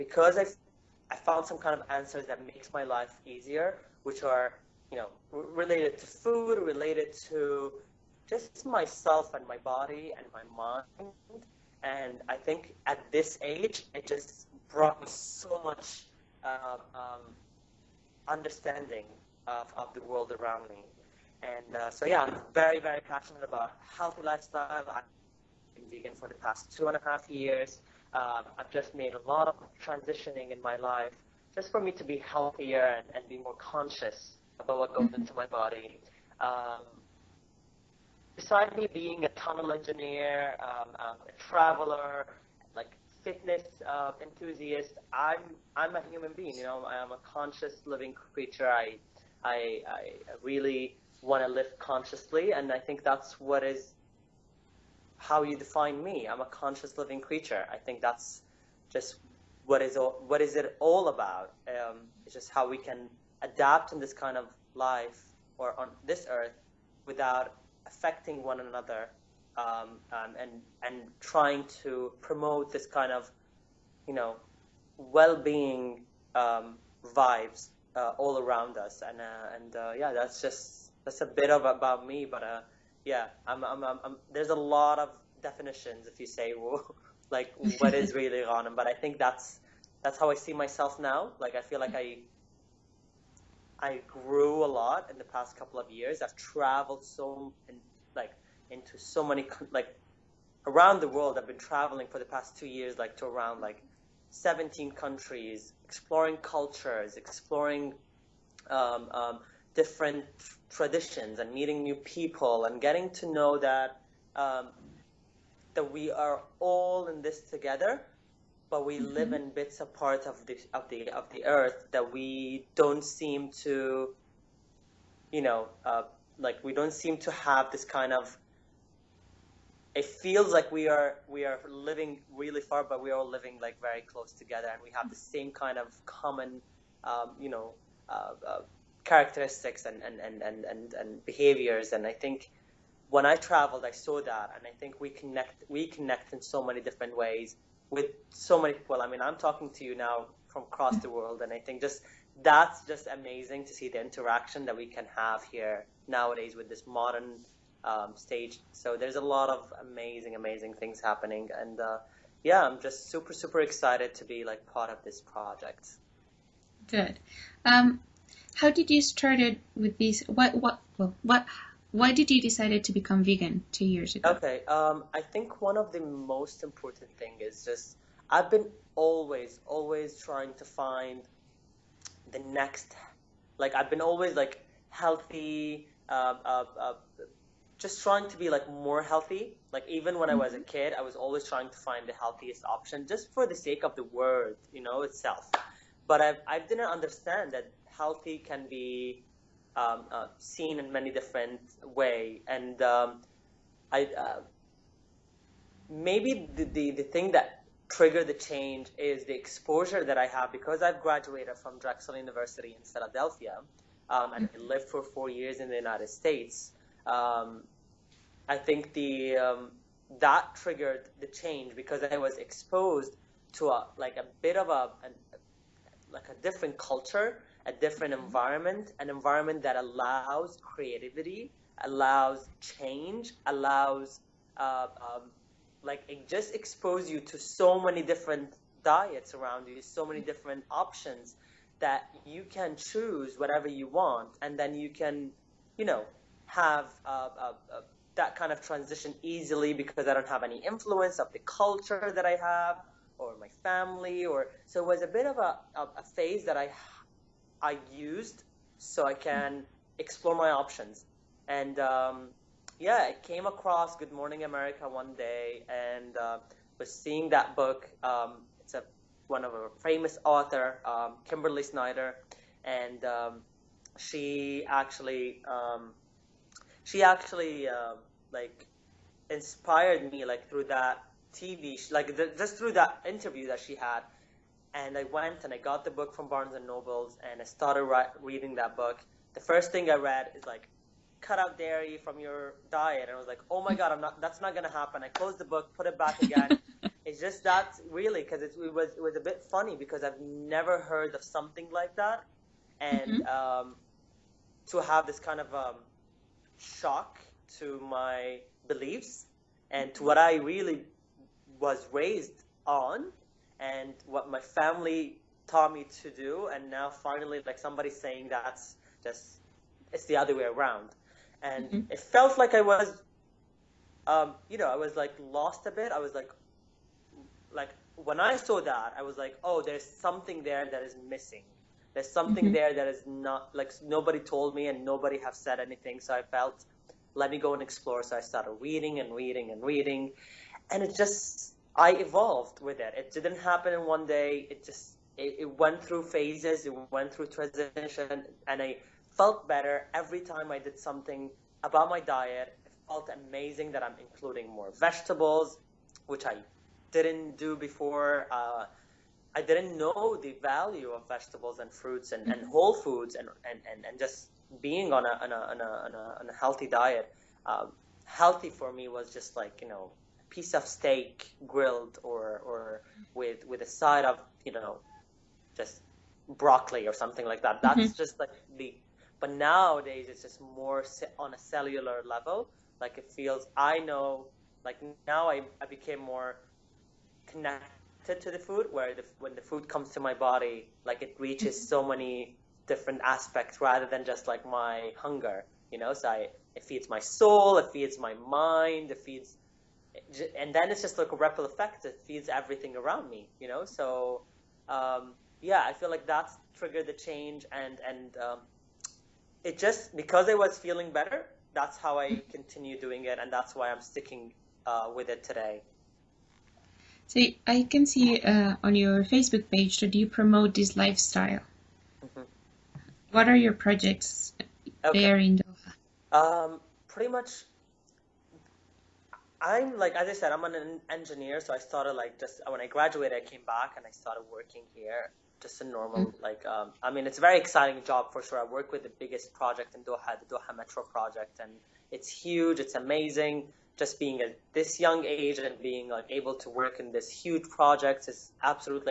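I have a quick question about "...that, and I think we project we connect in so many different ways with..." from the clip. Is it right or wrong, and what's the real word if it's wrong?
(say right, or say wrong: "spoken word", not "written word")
wrong: "connect", not "project".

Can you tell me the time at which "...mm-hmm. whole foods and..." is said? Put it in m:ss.
6:02.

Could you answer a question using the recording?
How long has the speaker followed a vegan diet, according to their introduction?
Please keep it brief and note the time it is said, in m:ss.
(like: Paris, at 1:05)
2.5 years, at 0:26.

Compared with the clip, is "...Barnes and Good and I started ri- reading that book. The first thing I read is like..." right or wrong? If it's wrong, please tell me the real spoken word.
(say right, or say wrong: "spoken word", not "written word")
wrong: "Nobles", not "Good".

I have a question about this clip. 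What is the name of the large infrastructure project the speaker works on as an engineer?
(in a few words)
Doha Metro.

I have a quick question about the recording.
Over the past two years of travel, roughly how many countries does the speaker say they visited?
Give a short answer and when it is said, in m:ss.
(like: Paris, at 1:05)
17, at 1:44.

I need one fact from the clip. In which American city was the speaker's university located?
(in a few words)
Philadelphia.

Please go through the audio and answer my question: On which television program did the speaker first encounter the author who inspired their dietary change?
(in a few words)
Good Morning America.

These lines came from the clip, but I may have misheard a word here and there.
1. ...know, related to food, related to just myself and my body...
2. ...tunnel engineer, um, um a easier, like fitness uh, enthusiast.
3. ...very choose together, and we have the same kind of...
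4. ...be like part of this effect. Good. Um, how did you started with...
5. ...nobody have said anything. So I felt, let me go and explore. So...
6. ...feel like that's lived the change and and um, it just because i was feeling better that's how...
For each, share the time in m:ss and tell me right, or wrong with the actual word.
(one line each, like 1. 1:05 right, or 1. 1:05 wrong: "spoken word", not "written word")
1. 0:04 right
2. 0:39 wrong: "traveler", not "easier"
3. 2:13 wrong: "close", not "choose"
4. 2:44 wrong: "project", not "effect"
5. 5:34 right
6. 6:45 wrong: "triggered", not "lived".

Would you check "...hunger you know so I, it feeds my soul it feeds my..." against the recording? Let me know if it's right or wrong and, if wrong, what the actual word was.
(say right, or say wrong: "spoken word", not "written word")
right.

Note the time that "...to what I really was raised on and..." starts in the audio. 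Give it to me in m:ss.
5:09.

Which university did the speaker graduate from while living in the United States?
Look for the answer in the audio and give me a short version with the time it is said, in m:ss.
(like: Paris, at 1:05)
Drexel University, at 3:31.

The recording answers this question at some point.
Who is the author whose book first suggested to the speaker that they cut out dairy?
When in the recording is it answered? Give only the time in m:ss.
4:31.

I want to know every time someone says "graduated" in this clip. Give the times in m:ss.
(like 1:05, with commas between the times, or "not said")
3:31, 7:12.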